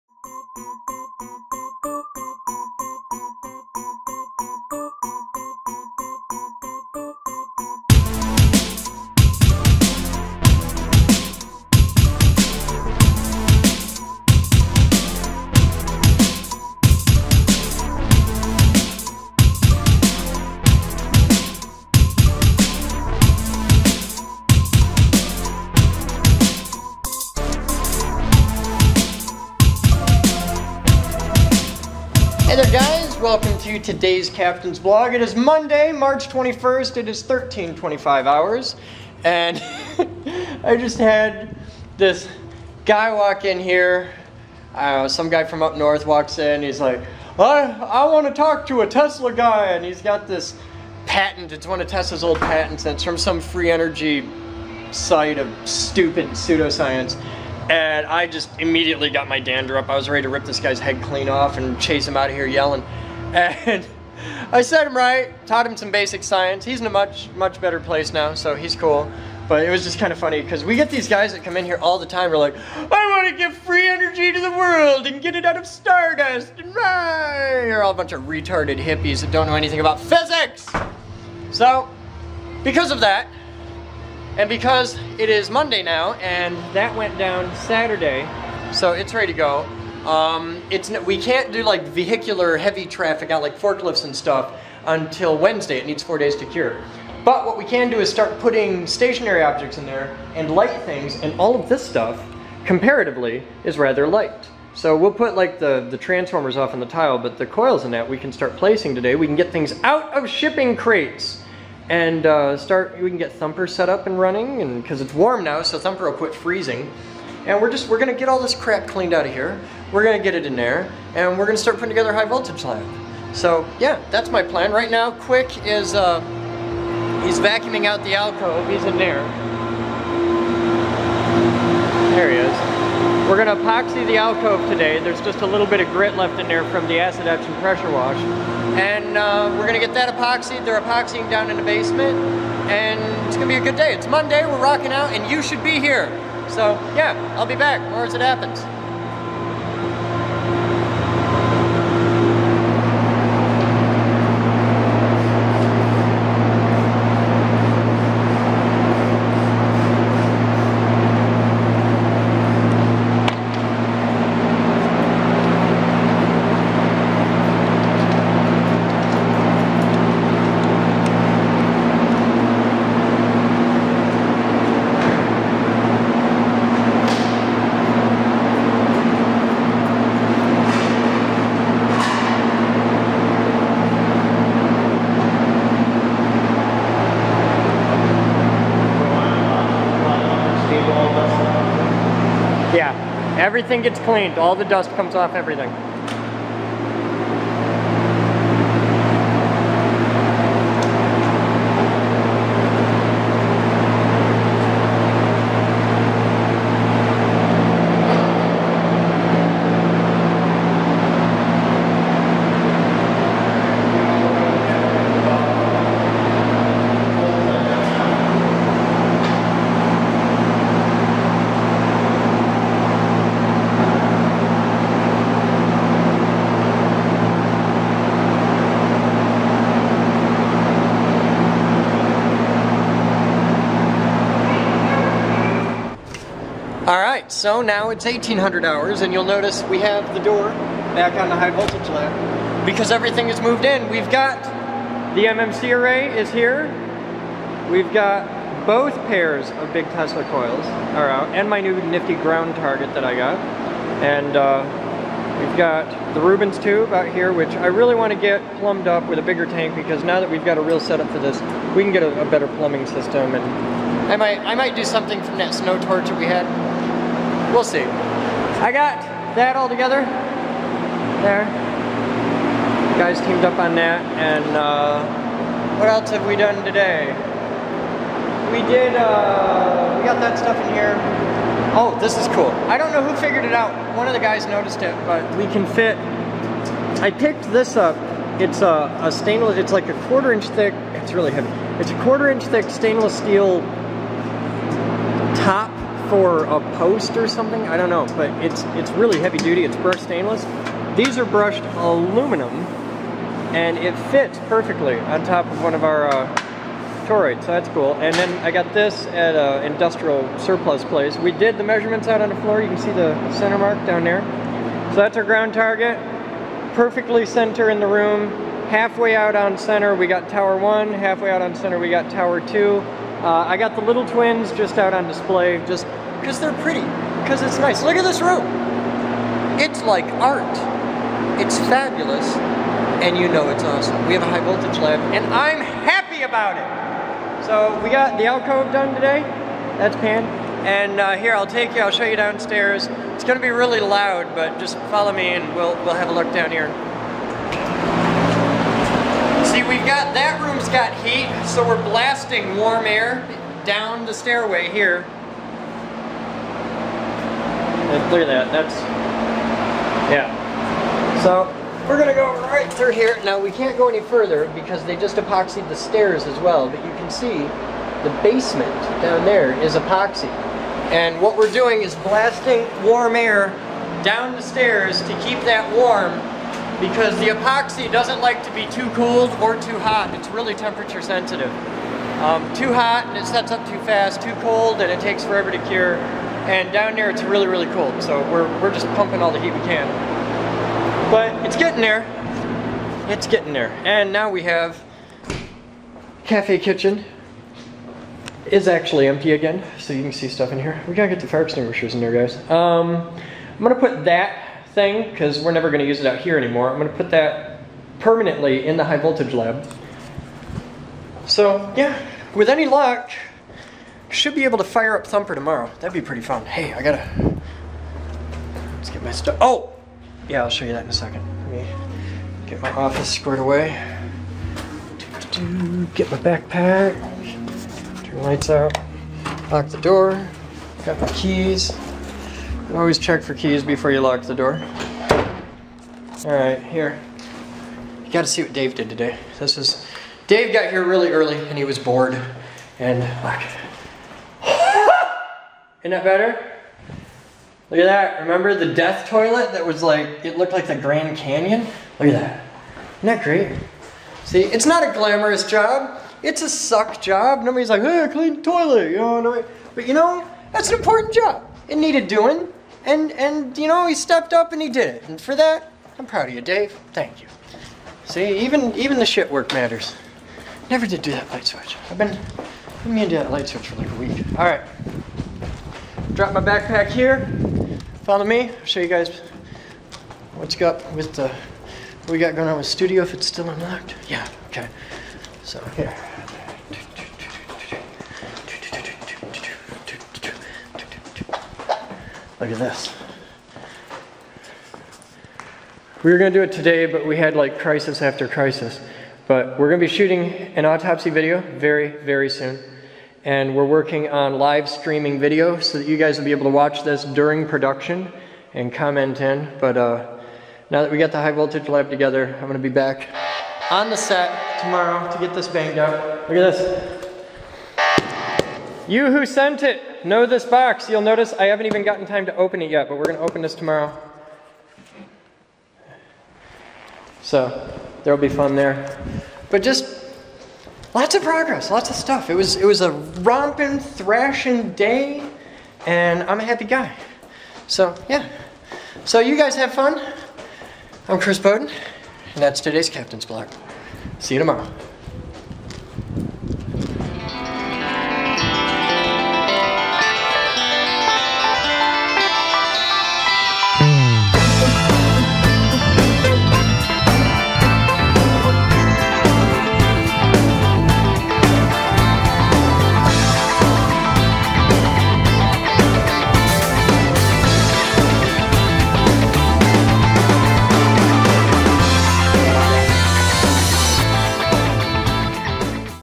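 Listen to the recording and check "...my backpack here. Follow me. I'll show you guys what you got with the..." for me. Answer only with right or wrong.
right.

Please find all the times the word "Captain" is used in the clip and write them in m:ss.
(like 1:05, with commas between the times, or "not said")
0:34, 9:02.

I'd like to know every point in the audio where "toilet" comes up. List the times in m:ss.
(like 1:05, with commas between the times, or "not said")
7:29, 7:38.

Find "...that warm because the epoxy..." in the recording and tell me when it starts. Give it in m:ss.
6:15.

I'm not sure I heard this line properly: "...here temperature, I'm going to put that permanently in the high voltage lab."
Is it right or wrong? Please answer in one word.
wrong.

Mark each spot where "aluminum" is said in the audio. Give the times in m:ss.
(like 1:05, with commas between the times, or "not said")
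5:01.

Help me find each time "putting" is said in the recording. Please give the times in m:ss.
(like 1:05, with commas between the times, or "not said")
1:38, 2:01.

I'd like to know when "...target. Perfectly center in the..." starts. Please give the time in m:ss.
5:15.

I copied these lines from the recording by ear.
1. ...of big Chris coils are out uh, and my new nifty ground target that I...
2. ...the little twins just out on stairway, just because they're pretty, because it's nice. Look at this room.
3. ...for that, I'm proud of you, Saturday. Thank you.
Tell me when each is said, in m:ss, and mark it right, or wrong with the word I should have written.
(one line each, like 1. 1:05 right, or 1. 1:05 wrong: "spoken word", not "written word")
1. 4:09 wrong: "Tesla", not "Chris"
2. 5:23 wrong: "display", not "stairway"
3. 7:45 wrong: "Dave", not "Saturday".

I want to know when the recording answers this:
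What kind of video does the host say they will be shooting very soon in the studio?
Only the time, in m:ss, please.
8:20.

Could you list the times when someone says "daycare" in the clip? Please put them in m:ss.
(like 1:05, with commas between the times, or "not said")
not said.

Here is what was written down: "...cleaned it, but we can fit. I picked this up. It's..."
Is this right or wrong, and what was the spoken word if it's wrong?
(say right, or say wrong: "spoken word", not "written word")
wrong: "noticed", not "cleaned".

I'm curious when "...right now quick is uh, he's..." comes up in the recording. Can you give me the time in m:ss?
2:04.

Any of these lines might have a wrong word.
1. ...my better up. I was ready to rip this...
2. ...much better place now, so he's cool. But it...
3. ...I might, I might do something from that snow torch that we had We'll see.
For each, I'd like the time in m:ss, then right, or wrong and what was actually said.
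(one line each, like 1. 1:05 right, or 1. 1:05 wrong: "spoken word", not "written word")
1. 0:59 wrong: "dander", not "better"
2. 1:07 right
3. 4:24 right.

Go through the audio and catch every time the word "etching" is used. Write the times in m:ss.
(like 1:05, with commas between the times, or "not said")
2:17.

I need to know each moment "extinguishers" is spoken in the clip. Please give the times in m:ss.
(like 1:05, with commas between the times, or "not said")
6:41.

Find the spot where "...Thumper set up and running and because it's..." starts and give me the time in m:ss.
1:53.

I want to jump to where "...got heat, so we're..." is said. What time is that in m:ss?
5:50.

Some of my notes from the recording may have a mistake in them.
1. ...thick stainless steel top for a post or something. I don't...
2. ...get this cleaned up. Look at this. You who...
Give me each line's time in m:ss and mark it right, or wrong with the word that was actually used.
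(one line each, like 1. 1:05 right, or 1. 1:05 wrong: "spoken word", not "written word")
1. 4:52 right
2. 8:35 wrong: "banged", not "cleaned".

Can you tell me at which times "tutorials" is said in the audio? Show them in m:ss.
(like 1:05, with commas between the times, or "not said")
not said.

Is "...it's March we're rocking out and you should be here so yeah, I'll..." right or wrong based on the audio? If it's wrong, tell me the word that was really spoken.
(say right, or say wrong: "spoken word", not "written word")
wrong: "Monday", not "March".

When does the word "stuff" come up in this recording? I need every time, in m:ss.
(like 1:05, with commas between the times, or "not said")
1:34, 1:41, 4:40, 6:40, 6:59, 8:51.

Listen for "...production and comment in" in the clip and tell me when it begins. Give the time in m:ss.
8:27.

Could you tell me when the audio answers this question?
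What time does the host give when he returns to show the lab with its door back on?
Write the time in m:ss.
3:58.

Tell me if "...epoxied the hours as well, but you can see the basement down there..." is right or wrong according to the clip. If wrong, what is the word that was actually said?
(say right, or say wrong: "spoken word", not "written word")
wrong: "stairs", not "hours".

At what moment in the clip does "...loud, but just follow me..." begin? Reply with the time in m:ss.
5:43.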